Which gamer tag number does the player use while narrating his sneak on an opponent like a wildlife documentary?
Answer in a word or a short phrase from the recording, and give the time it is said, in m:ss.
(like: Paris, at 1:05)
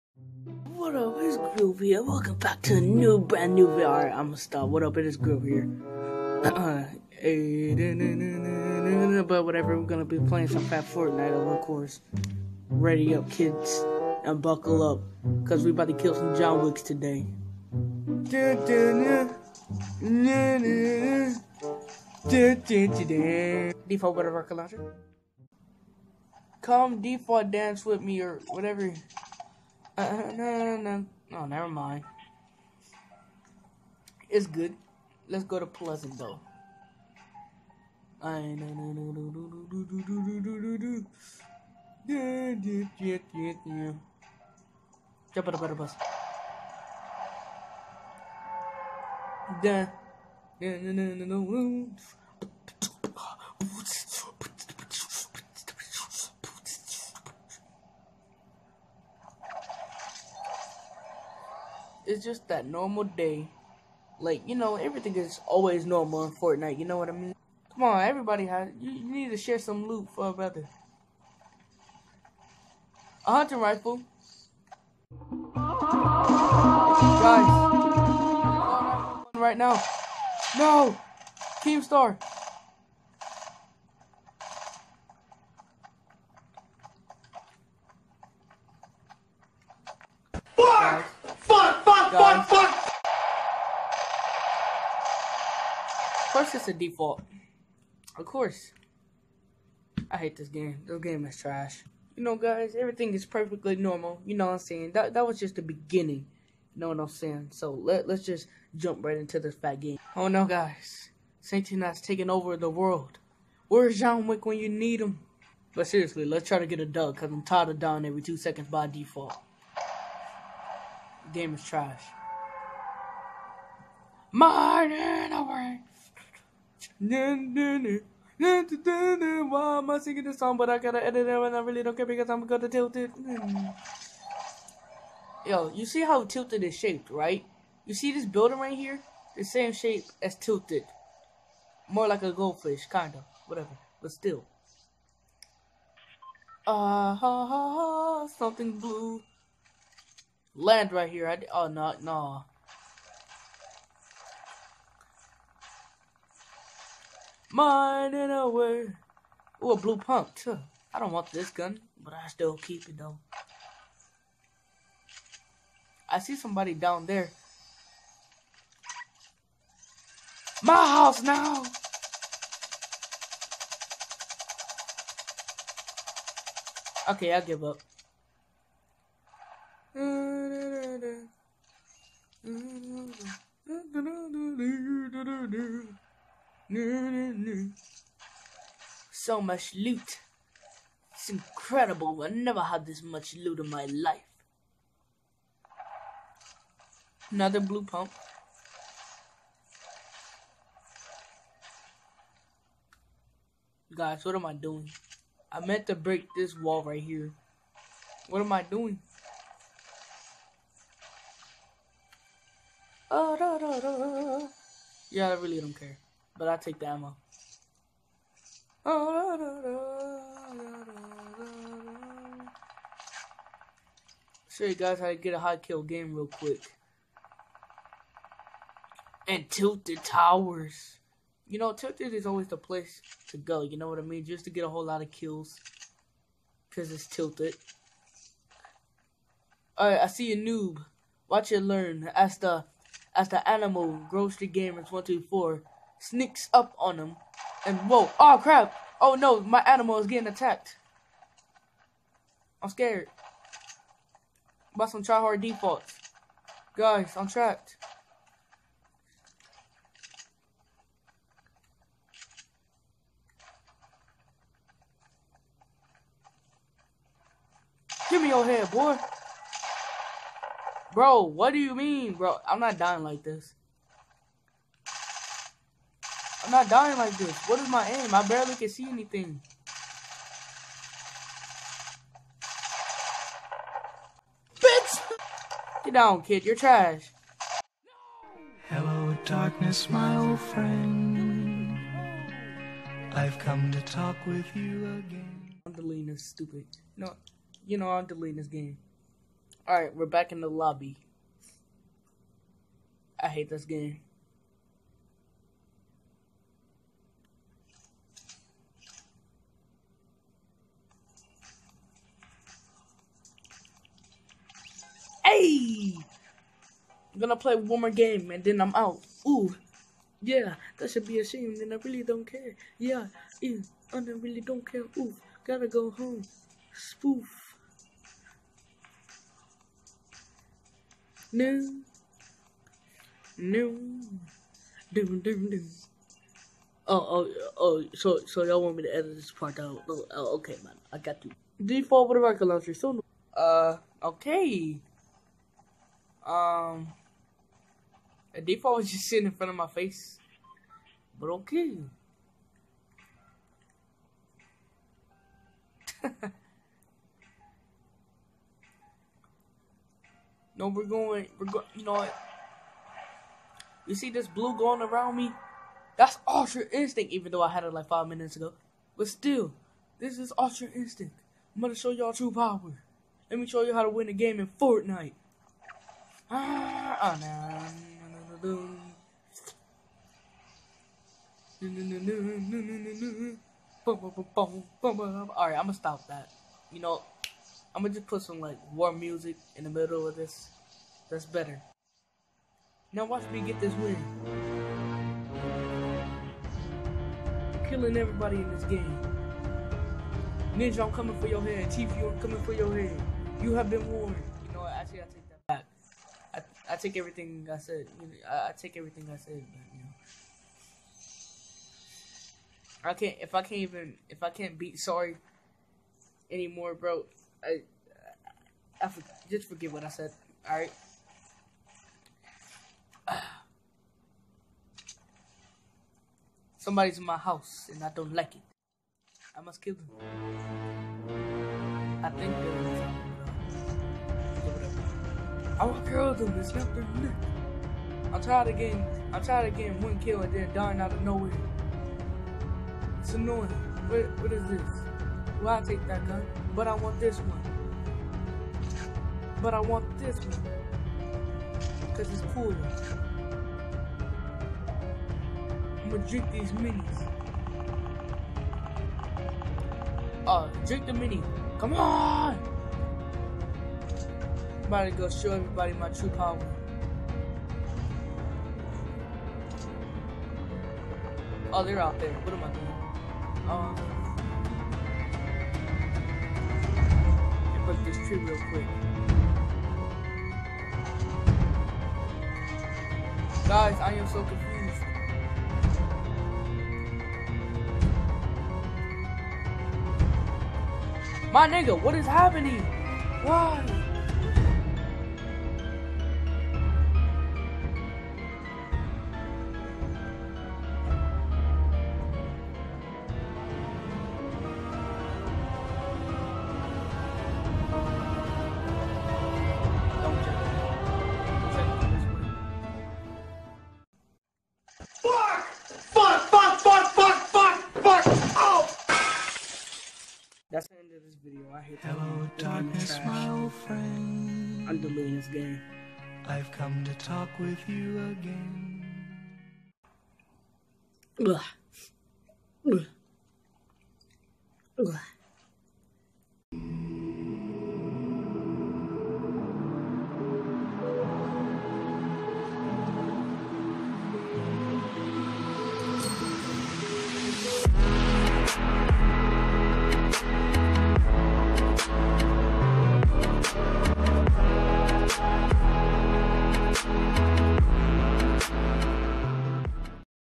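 124, at 4:04.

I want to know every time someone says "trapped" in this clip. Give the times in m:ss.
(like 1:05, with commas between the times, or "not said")
4:17.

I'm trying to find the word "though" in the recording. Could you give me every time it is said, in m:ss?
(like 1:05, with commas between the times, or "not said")
0:36, 2:42, 6:07.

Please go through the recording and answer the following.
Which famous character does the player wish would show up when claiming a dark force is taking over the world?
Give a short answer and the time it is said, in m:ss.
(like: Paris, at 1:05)
John Wick, at 1:53.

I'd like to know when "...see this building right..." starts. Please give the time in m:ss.
2:17.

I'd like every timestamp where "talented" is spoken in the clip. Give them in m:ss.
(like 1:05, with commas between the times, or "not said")
not said.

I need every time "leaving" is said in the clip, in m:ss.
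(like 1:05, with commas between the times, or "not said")
not said.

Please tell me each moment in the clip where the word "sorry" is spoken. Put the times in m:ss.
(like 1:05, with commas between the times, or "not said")
6:54.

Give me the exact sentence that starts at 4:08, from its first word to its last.
Oh no, my animal is getting attacked.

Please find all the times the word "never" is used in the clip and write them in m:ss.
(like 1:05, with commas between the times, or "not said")
0:31, 3:12.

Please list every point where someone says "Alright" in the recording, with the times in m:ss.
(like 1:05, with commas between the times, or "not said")
3:59, 6:24.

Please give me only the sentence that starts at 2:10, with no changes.
But I gotta edit it and I really don't care because I'm gonna tilt it.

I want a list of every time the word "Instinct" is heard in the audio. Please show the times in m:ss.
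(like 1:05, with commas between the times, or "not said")
6:06, 6:10.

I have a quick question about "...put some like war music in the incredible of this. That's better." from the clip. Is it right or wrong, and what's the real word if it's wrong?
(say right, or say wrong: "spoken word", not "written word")
wrong: "middle", not "incredible".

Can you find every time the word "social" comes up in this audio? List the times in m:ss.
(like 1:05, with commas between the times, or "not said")
not said.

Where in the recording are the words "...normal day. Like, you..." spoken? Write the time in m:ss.
1:02.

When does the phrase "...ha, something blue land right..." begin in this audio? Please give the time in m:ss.
2:27.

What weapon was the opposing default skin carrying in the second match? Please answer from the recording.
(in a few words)
A rocket launcher.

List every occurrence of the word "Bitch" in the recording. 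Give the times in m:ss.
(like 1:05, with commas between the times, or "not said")
4:44.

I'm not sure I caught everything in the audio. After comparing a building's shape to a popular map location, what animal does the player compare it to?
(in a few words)
A goldfish.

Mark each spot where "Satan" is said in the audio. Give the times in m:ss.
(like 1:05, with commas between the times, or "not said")
1:51.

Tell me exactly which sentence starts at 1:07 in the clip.
Come on, everybody has you, you need to share some loot for a brother.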